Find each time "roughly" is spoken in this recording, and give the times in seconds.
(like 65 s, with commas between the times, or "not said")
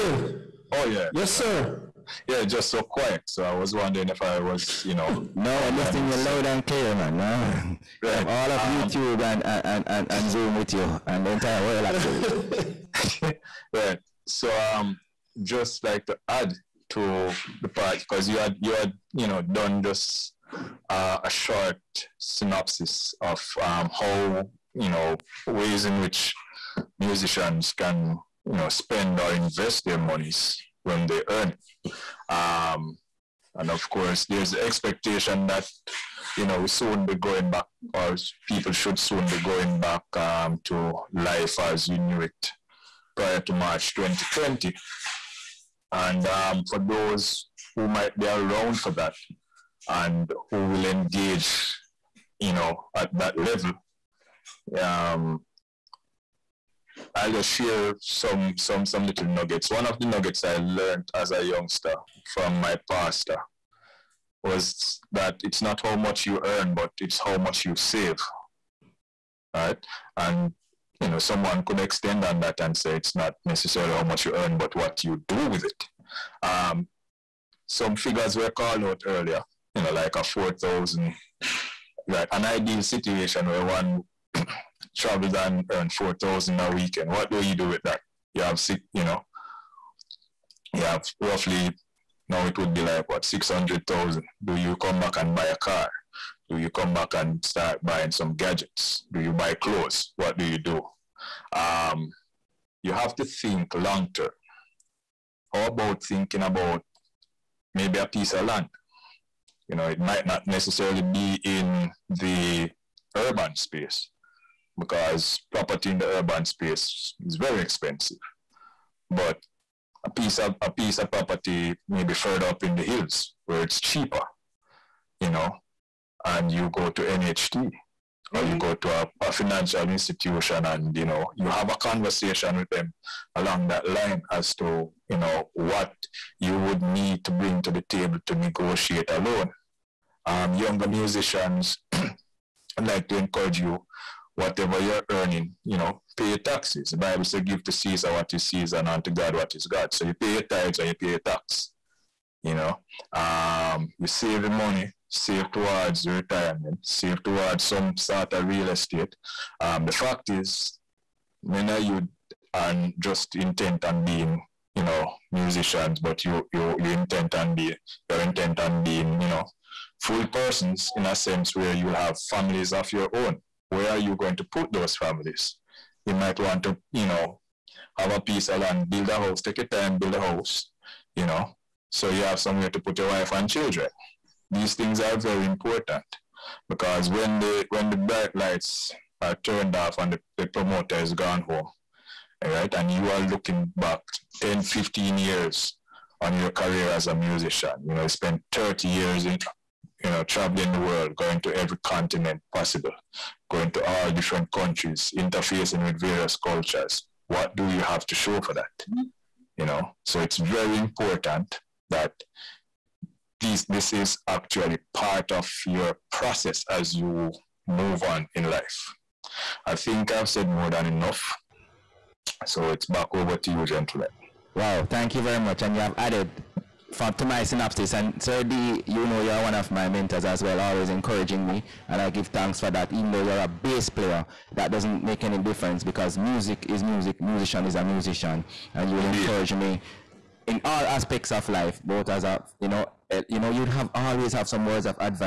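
91 s.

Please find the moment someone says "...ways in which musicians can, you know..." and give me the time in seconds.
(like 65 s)
25 s.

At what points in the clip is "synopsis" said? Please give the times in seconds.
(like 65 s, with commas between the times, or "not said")
22 s, 227 s.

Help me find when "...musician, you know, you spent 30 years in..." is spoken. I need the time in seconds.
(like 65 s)
197 s.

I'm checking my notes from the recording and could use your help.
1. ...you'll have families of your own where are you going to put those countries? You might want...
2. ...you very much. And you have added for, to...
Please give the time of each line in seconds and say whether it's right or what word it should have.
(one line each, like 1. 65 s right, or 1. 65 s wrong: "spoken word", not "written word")
1. 171 s wrong: "families", not "countries"
2. 225 s right.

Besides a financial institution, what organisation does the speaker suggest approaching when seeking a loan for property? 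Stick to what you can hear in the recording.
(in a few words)
NHT.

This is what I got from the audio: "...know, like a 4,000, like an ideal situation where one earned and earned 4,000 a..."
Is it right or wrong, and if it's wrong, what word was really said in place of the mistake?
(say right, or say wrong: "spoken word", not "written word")
wrong: "traveled", not "earned".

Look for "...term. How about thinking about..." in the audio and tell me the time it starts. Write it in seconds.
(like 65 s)
104 s.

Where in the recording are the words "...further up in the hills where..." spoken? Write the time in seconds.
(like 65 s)
122 s.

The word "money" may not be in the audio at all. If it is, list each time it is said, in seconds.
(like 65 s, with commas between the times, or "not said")
154 s.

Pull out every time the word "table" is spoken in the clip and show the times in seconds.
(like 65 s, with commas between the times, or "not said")
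137 s.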